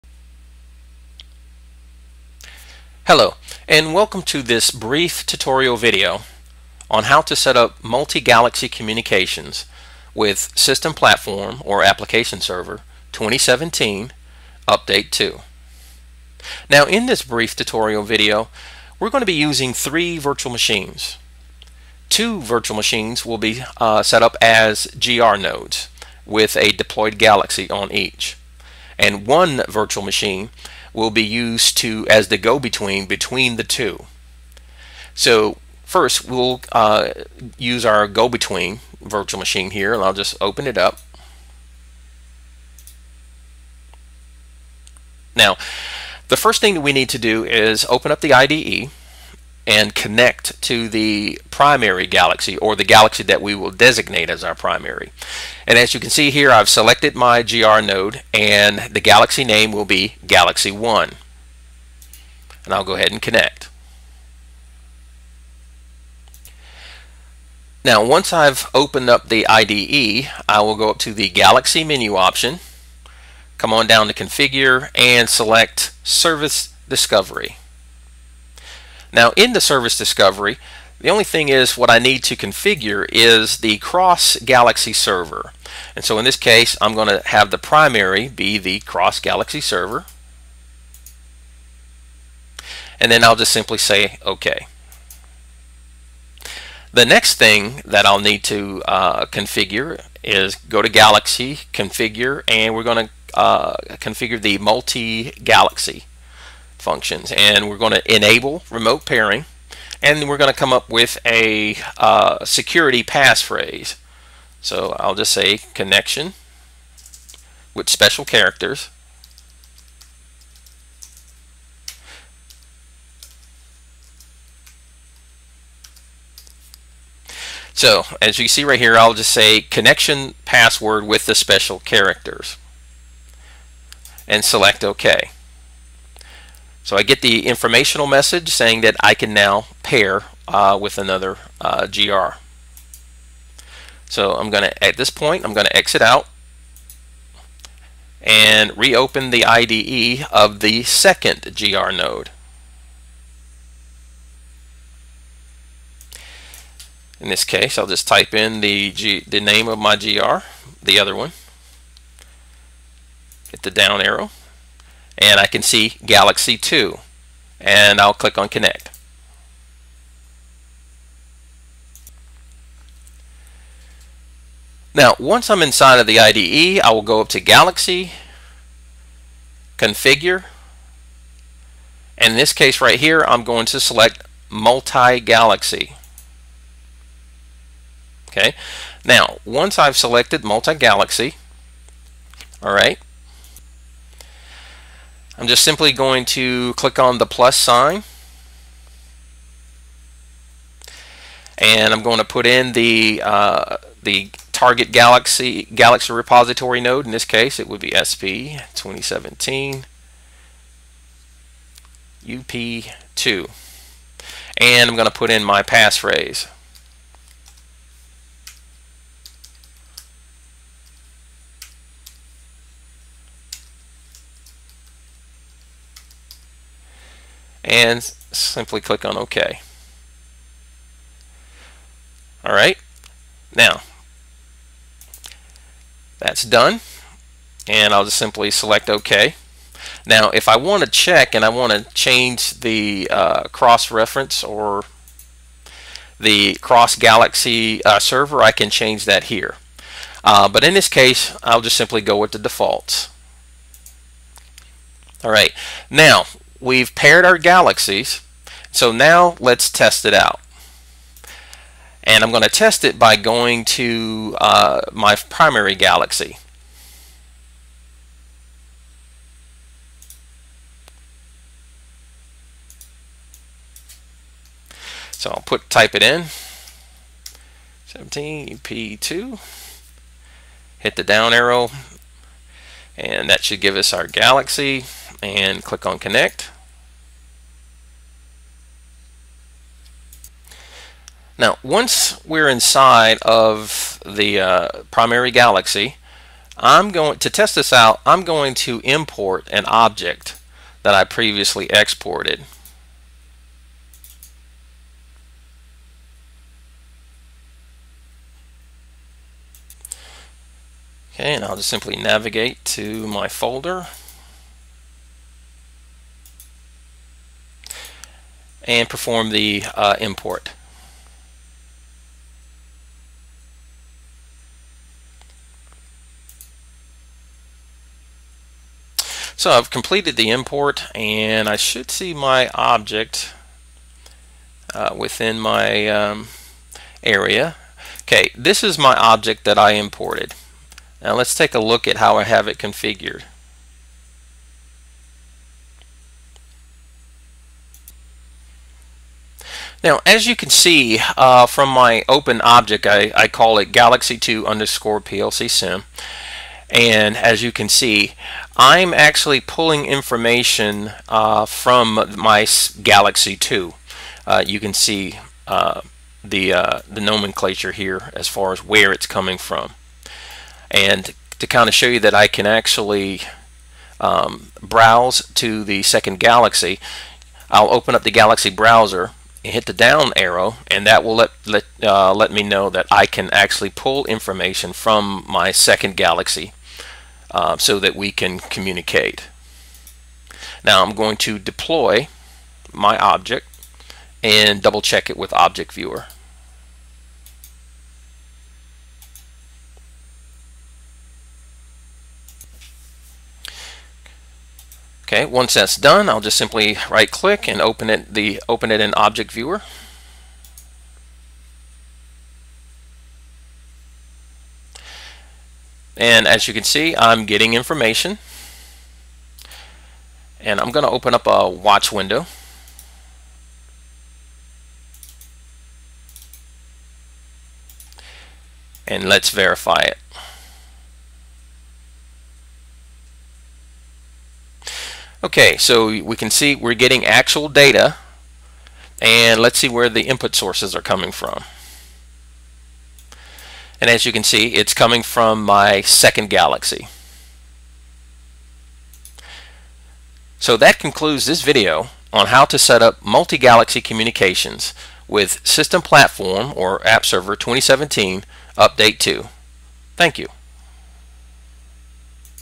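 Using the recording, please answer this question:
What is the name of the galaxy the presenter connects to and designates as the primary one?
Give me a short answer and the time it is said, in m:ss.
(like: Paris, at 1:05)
Galaxy 1, at 1:00.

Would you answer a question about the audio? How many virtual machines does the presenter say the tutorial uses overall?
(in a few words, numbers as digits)
3.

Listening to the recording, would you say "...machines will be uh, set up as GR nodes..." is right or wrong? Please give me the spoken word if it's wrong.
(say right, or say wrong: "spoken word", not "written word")
right.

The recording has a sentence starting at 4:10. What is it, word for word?
Uh, but in this case I'll just simply go with the defaults.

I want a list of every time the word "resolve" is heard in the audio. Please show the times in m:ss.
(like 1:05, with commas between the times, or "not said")
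not said.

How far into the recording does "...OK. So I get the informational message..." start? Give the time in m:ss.
2:14.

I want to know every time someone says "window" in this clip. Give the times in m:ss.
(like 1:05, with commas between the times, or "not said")
7:01.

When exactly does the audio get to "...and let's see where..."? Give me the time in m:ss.
7:18.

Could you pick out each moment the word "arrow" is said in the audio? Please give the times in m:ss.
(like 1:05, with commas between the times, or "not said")
2:44, 4:41, 6:20.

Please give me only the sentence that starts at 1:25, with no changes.
And so in this case, I'm going to have the primary be the cross galaxy server.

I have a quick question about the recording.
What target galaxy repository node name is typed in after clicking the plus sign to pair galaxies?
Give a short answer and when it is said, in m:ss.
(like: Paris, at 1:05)
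SP 2017 UP2, at 3:27.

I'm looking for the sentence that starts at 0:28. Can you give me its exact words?
And one virtual machine will be used to as the go-between between the two.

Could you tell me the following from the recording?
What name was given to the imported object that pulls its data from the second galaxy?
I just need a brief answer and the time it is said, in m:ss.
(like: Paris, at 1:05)
Galaxy 2_PLC sim, at 5:53.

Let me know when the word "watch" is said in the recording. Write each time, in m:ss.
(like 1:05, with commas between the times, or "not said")
7:01.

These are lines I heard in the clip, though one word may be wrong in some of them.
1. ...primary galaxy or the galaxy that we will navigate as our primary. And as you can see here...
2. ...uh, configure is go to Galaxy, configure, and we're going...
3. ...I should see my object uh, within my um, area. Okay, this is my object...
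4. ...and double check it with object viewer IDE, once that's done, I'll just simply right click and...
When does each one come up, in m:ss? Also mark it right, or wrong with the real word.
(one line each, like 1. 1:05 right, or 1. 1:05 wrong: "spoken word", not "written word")
1. 0:51 wrong: "designate", not "navigate"
2. 1:38 right
3. 5:31 right
4. 6:34 wrong: "Okay", not "IDE".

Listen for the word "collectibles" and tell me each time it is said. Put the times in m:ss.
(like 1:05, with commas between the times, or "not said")
not said.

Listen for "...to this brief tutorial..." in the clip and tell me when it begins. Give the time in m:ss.
0:04.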